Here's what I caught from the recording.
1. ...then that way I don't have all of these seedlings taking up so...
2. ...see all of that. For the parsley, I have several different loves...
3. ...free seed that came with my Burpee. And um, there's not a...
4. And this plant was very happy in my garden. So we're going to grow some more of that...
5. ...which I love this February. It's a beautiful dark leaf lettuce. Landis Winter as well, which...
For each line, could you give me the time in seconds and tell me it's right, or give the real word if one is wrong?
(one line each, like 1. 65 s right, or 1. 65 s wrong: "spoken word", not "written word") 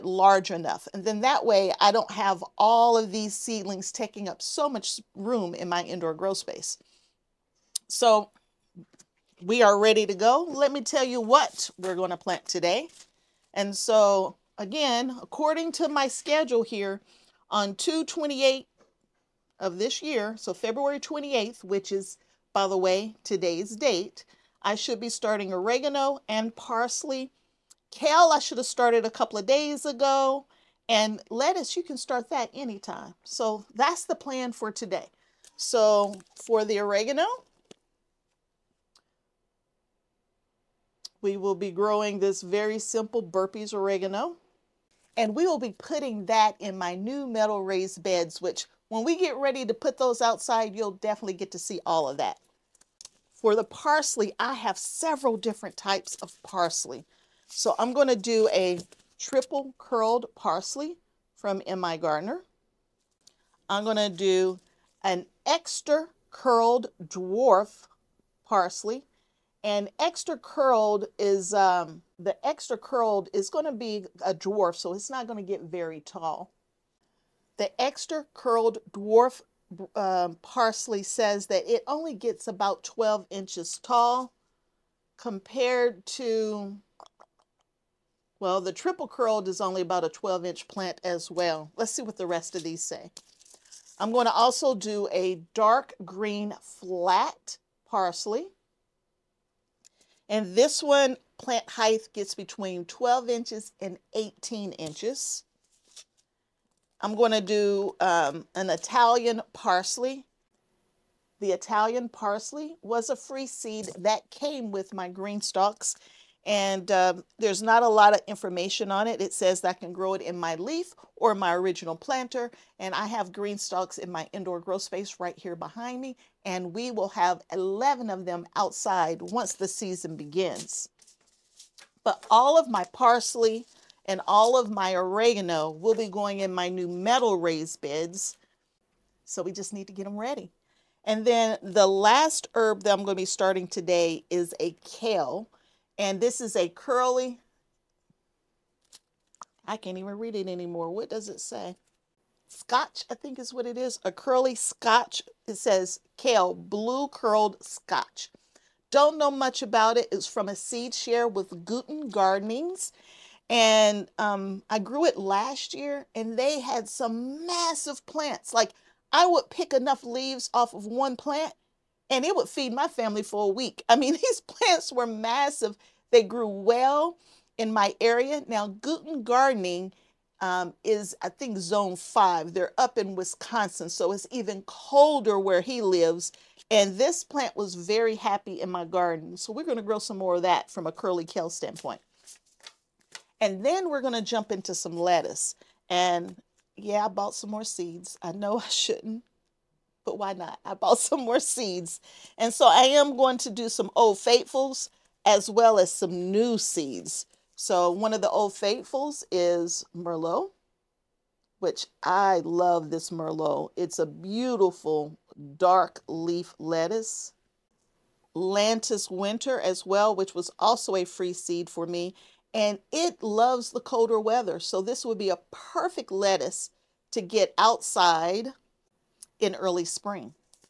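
1. 1 s right
2. 51 s wrong: "types", not "loves"
3. 113 s wrong: "GreenStalks", not "Burpee"
4. 186 s right
5. 211 s wrong: "Merlot", not "February".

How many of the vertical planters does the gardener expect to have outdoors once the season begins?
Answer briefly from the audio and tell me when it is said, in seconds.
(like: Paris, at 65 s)
11, at 127 s.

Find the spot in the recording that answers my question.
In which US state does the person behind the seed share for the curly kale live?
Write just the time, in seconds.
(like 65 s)
183 s.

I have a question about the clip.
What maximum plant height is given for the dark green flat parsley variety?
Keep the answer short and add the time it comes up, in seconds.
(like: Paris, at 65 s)
18 inches, at 104 s.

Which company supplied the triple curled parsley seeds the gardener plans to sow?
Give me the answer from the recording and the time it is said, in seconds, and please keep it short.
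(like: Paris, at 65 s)
MIgardener, at 61 s.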